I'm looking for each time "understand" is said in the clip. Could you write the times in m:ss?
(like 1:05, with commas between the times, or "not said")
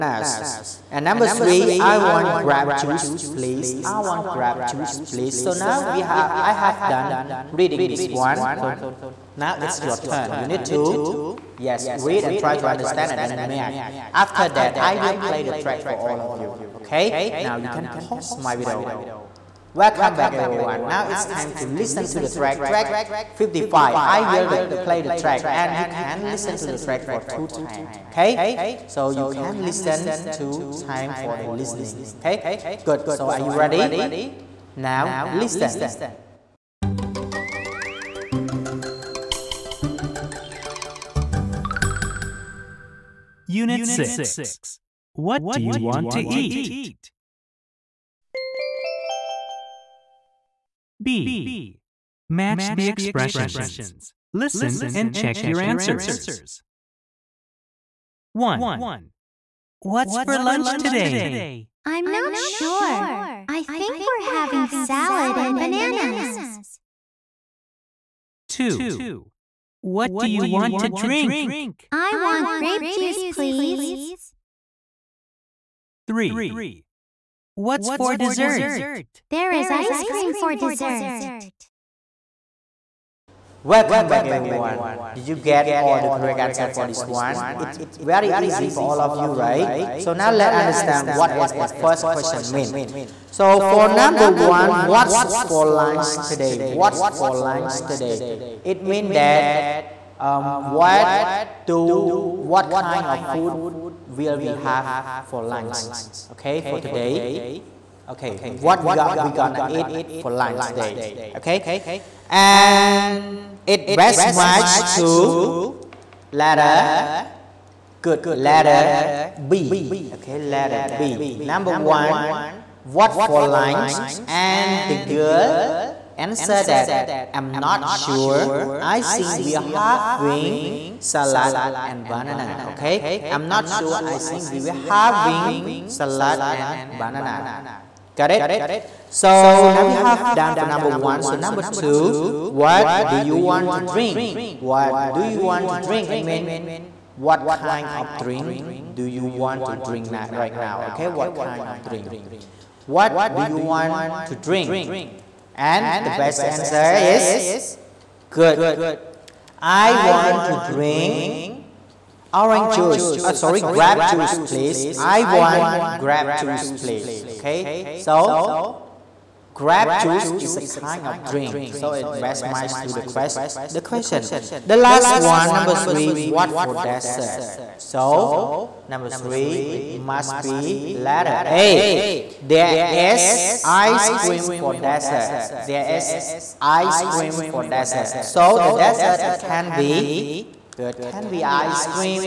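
0:12, 1:30.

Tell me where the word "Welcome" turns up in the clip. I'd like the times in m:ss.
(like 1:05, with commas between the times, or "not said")
0:19, 1:23.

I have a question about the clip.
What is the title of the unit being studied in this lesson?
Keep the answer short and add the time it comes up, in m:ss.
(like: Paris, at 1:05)
What do you want to eat?, at 0:45.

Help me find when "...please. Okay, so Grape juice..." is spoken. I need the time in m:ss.
2:46.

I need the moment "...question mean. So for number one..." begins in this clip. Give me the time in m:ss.
1:32.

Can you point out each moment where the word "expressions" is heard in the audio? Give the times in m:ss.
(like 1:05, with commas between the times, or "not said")
0:52.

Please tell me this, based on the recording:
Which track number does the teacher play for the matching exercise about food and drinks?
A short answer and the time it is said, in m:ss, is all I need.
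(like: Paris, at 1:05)
55, at 0:22.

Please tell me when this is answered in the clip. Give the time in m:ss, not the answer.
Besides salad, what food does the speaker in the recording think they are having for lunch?
1:04.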